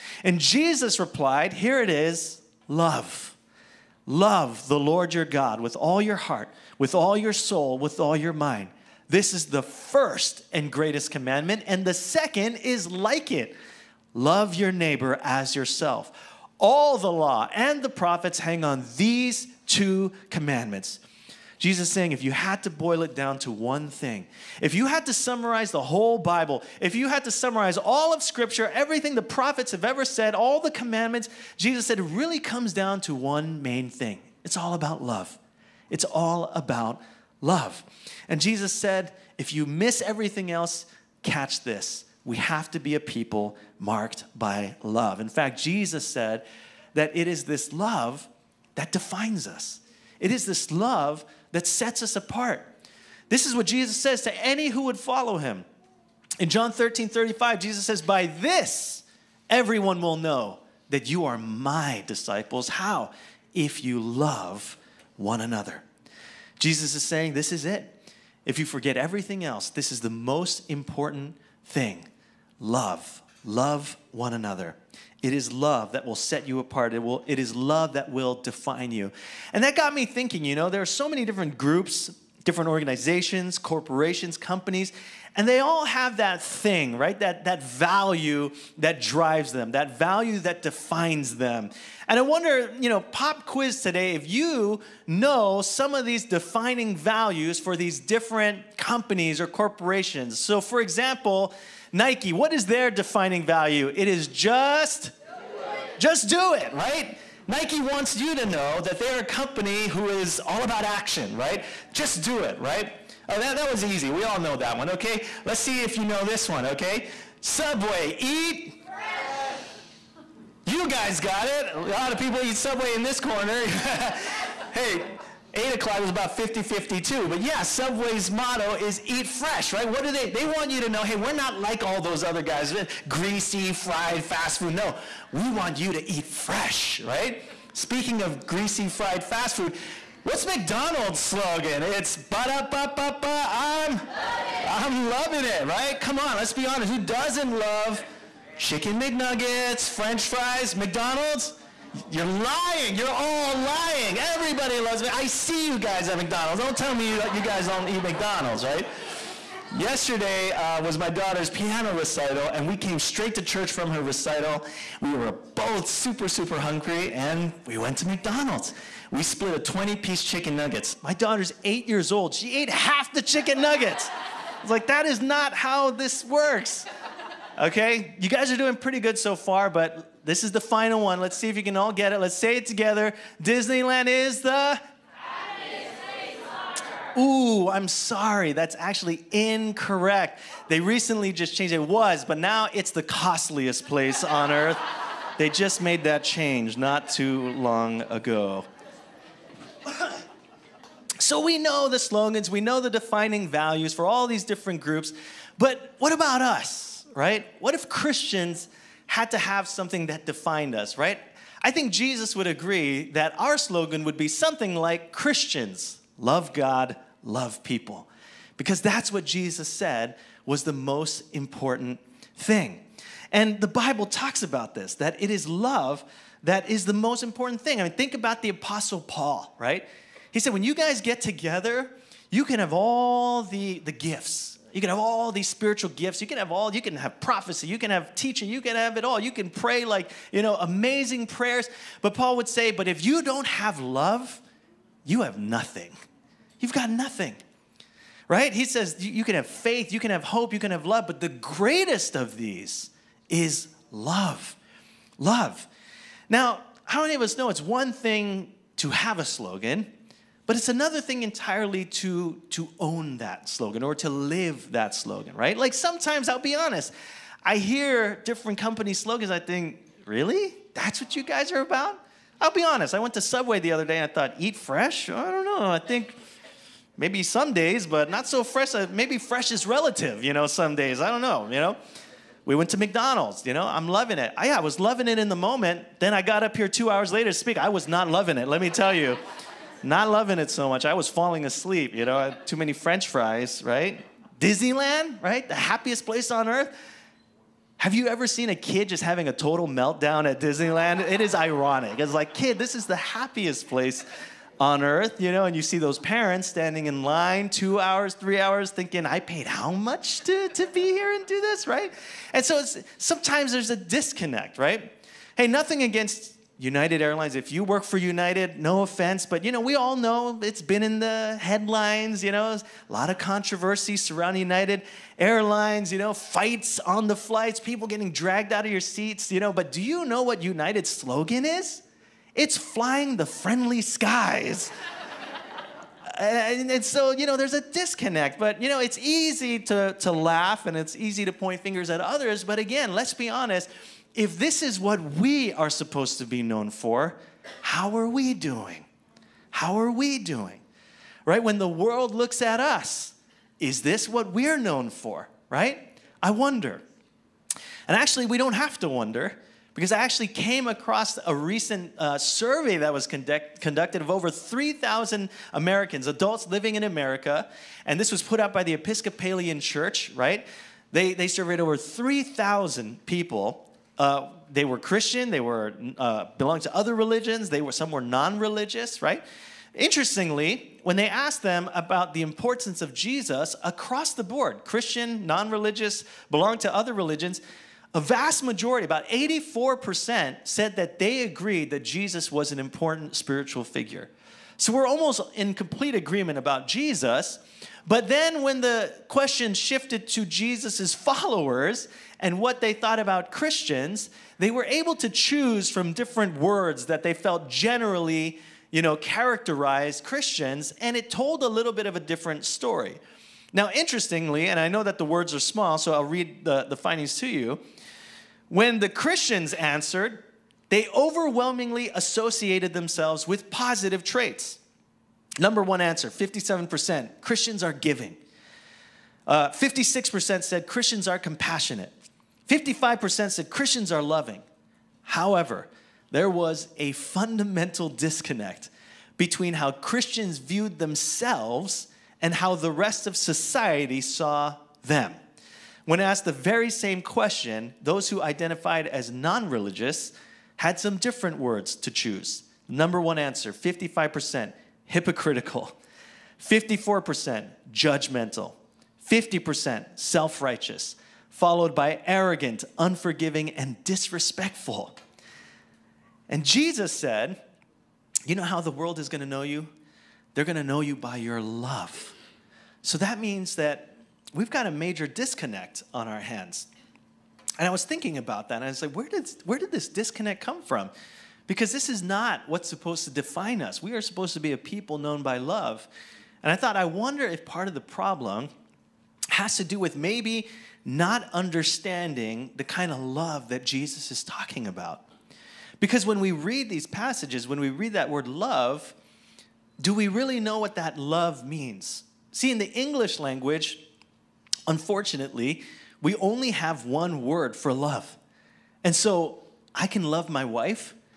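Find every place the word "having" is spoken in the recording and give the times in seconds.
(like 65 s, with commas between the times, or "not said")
299 s.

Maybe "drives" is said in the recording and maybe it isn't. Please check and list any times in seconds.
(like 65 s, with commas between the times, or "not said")
88 s.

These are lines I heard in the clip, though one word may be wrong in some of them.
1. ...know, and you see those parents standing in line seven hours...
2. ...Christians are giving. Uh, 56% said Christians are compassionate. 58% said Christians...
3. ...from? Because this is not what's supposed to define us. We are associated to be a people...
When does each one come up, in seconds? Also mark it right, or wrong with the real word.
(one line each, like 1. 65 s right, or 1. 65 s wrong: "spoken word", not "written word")
1. 305 s wrong: "two", not "seven"
2. 427 s wrong: "55", not "58"
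3. 480 s wrong: "supposed", not "associated".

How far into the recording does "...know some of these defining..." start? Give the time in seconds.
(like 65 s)
95 s.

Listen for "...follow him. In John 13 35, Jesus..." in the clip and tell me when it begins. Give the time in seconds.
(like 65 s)
54 s.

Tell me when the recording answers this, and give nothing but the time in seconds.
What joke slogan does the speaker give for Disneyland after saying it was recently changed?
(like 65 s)
193 s.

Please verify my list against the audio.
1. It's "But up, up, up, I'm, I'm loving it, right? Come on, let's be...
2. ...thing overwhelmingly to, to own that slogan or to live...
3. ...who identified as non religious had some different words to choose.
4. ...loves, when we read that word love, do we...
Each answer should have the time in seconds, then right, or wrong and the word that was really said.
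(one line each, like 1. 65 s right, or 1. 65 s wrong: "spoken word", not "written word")
1. 141 s right
2. 261 s wrong: "entirely", not "overwhelmingly"
3. 448 s right
4. 496 s wrong: "passages", not "loves".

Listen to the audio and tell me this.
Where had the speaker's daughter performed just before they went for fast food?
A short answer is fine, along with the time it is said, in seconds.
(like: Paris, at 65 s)
piano recital, at 161 s.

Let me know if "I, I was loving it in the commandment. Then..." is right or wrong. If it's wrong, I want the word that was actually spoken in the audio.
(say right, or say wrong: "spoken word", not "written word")
wrong: "moment", not "commandment".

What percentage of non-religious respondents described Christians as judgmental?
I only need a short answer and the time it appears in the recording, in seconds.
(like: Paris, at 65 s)
54%, at 456 s.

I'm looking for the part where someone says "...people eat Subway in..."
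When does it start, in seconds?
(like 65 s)
122 s.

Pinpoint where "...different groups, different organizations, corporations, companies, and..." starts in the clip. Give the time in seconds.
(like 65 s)
81 s.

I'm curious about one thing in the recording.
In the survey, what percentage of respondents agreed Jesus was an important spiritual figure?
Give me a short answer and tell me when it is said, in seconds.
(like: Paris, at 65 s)
84%, at 389 s.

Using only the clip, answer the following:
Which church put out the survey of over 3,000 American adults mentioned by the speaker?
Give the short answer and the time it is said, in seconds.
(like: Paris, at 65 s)
Episcopalian Church, at 368 s.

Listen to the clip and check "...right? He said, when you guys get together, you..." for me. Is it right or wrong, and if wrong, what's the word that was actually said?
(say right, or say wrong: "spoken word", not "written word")
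right.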